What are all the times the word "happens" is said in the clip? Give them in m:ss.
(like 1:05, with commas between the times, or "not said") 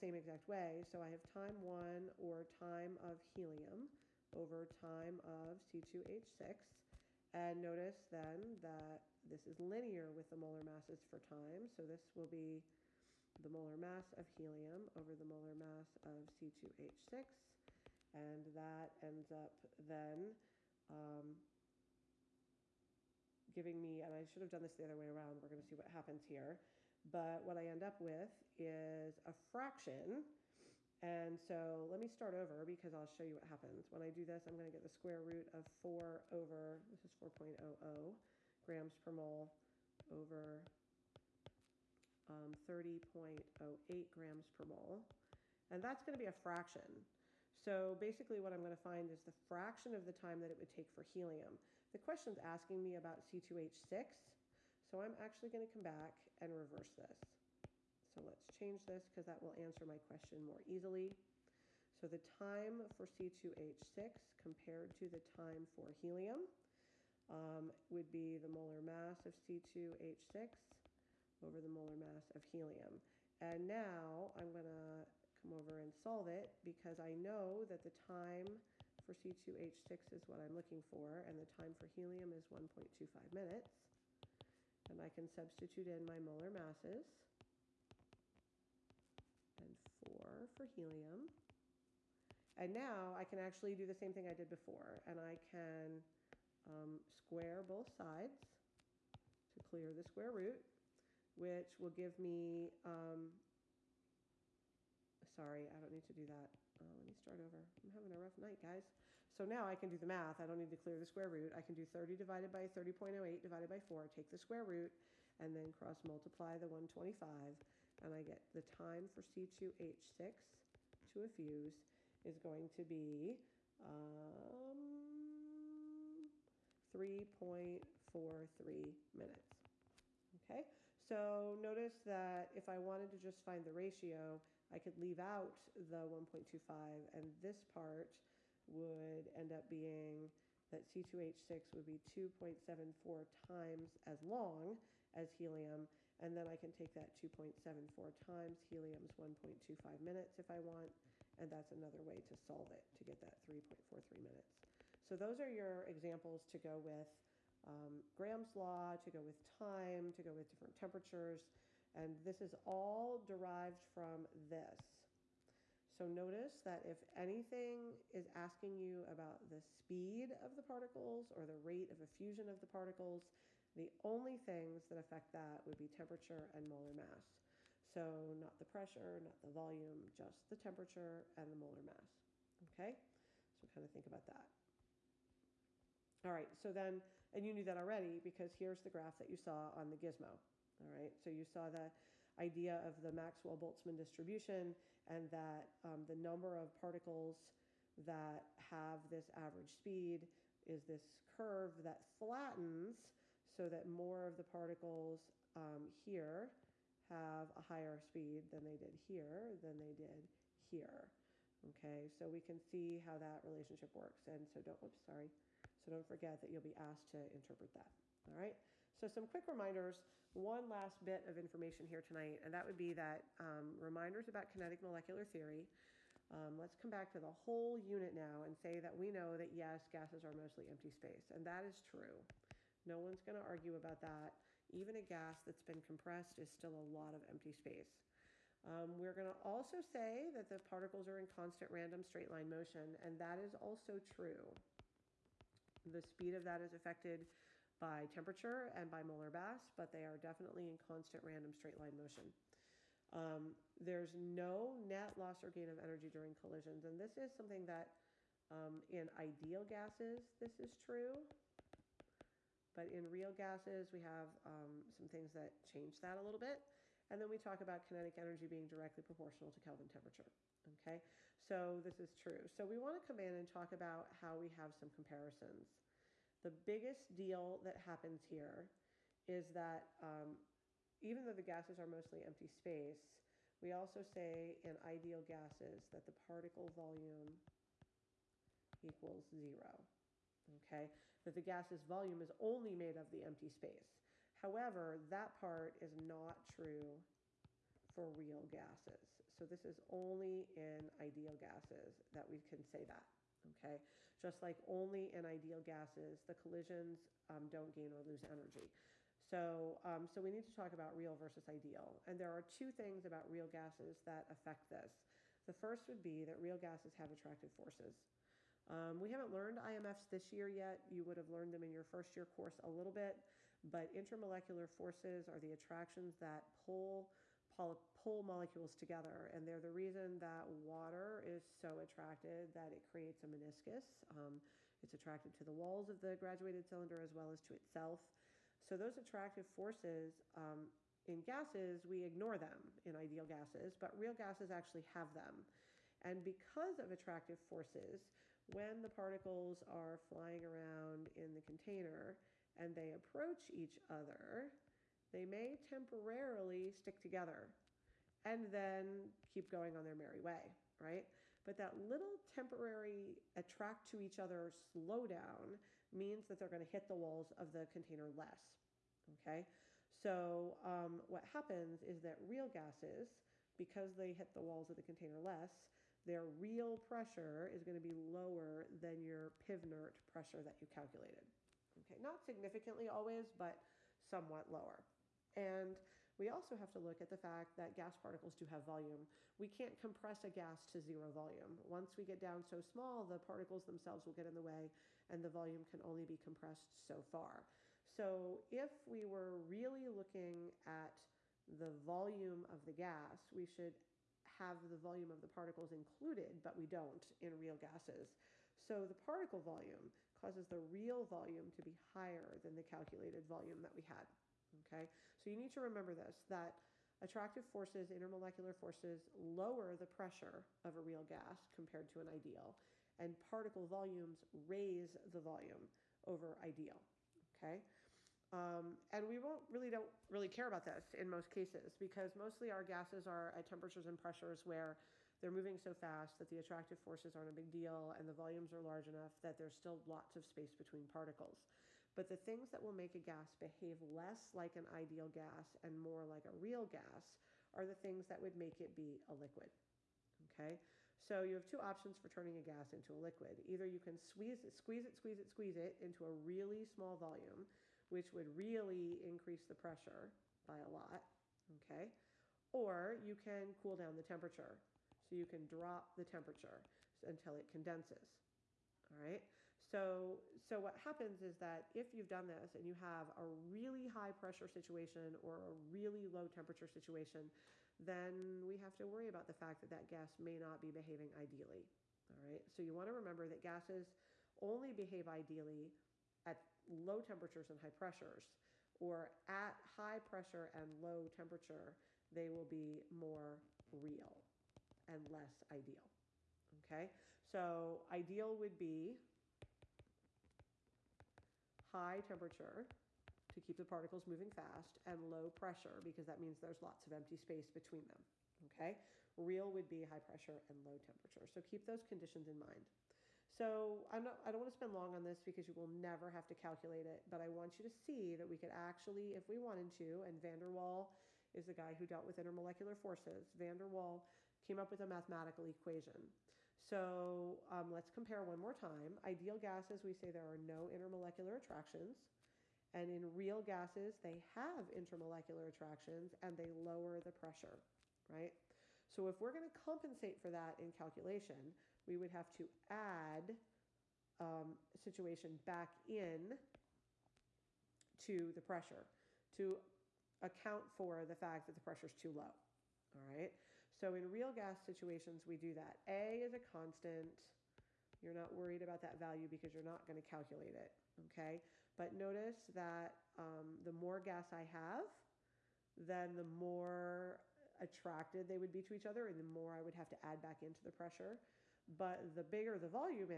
0:25, 0:33, 4:37, 6:11, 7:50.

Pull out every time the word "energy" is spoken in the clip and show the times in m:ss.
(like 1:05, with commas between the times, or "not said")
4:15, 4:28, 5:08.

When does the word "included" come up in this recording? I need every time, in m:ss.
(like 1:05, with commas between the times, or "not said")
6:45.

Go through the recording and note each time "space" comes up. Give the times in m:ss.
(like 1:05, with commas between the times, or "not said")
3:50, 3:57, 4:42, 4:53, 7:20, 8:27.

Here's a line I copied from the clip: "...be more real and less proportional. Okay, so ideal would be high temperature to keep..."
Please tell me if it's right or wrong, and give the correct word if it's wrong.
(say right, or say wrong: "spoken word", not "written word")
wrong: "ideal", not "proportional".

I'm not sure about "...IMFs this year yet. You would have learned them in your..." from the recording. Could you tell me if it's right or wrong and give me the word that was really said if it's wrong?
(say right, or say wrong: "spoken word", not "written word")
right.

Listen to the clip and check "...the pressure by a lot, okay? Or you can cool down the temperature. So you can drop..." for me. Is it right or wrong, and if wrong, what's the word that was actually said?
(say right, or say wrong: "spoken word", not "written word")
right.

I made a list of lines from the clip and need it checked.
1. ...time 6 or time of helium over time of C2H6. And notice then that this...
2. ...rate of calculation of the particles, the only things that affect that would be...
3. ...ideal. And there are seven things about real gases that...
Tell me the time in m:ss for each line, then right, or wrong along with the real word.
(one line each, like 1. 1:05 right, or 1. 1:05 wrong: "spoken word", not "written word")
1. 0:01 wrong: "1", not "6"
2. 2:51 wrong: "effusion", not "calculation"
3. 5:11 wrong: "two", not "seven".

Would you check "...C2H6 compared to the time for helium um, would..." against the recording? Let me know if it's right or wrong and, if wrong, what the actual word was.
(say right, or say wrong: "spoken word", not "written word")
right.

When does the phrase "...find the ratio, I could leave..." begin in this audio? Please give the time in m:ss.
2:13.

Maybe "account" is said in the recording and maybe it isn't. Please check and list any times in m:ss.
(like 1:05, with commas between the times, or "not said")
9:10.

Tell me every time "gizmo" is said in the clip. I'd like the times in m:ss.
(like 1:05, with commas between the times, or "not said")
3:09.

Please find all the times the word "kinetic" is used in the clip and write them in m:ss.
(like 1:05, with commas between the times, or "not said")
3:44, 4:27.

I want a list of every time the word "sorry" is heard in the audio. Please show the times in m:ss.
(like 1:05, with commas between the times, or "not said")
1:45, 3:35.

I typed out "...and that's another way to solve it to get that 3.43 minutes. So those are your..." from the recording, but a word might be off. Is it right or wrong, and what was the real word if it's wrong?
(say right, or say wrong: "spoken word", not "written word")
right.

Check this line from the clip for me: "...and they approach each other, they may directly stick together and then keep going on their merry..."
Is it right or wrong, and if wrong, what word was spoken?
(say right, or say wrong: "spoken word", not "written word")
wrong: "temporarily", not "directly".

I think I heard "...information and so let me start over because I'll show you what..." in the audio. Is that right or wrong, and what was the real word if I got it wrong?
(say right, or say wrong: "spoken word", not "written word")
wrong: "fraction", not "information".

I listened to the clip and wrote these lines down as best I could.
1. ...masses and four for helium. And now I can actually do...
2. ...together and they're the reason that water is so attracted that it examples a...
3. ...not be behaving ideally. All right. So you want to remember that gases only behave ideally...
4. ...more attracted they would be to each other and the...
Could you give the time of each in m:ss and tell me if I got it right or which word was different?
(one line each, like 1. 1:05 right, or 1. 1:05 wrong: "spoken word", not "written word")
1. 1:26 right
2. 5:28 wrong: "creates", not "examples"
3. 8:00 right
4. 9:26 right.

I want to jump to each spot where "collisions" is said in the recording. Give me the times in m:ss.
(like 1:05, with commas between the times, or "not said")
4:16, 5:06.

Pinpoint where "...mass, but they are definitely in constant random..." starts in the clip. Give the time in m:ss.
4:09.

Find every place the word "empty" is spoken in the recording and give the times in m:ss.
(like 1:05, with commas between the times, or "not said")
3:50, 3:57, 4:42, 4:53, 8:26.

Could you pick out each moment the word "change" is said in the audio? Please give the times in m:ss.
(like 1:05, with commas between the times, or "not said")
0:58, 4:25.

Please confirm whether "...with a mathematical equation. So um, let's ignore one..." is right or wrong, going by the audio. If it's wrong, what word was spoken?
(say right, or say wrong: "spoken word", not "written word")
wrong: "compare", not "ignore".